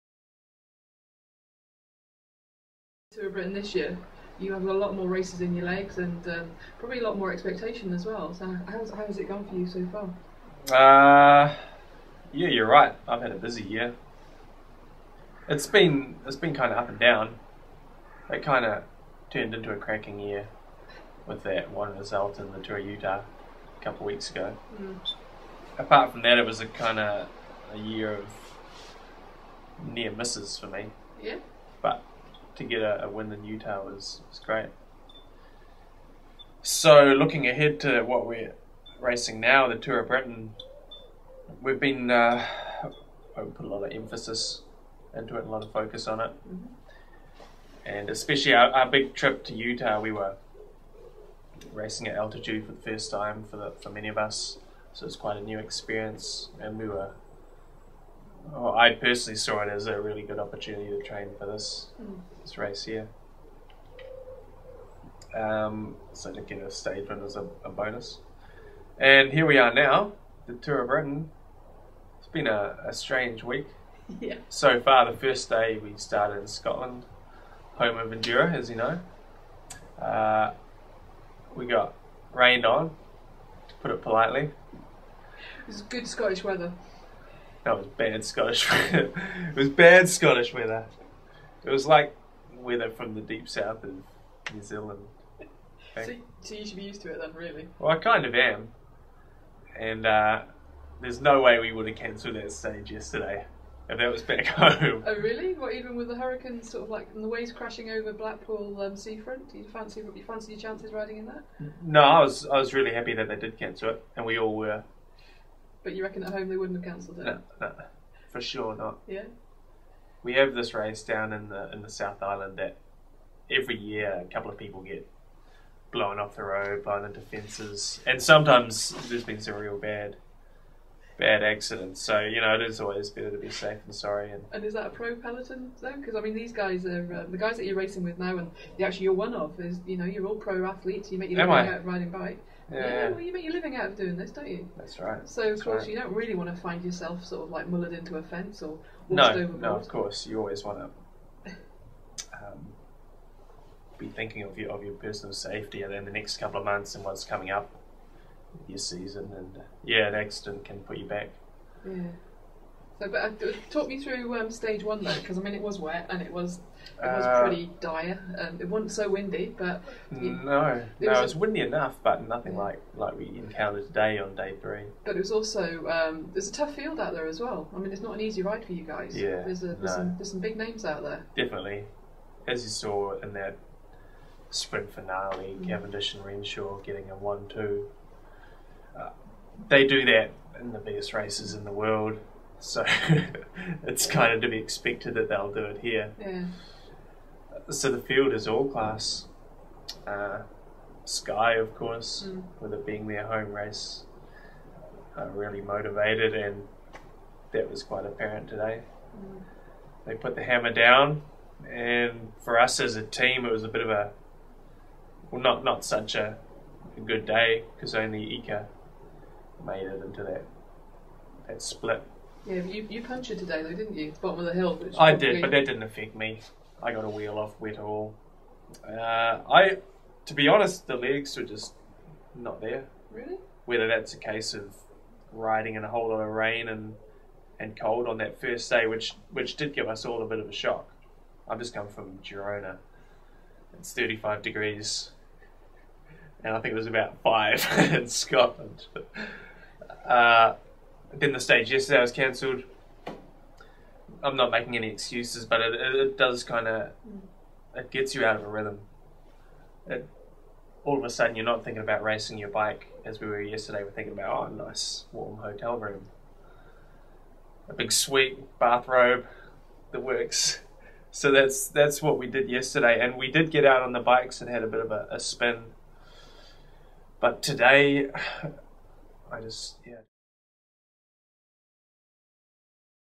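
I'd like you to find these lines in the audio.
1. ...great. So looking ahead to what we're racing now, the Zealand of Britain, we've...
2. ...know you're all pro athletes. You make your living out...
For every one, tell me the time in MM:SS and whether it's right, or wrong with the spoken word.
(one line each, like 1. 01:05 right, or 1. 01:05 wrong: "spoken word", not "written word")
1. 00:34 wrong: "Tour", not "Zealand"
2. 02:19 right.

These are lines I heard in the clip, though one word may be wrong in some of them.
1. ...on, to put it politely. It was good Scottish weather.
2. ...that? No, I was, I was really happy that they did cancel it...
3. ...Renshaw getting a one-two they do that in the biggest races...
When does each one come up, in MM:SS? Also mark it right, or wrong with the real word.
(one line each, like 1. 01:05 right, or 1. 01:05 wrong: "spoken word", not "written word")
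1. 01:22 right
2. 01:51 right
3. 03:06 right.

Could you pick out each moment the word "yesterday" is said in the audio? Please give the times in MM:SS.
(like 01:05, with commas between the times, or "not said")
01:42, 04:11, 04:23, 04:32.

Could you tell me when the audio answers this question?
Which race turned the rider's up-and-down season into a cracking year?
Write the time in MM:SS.
00:22.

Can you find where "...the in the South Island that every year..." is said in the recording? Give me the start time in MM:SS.
02:01.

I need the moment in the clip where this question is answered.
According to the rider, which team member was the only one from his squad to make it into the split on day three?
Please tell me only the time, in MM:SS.
03:38.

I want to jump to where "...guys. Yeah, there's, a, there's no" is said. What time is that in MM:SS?
02:58.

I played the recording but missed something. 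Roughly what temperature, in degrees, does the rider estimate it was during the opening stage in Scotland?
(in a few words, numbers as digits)
5.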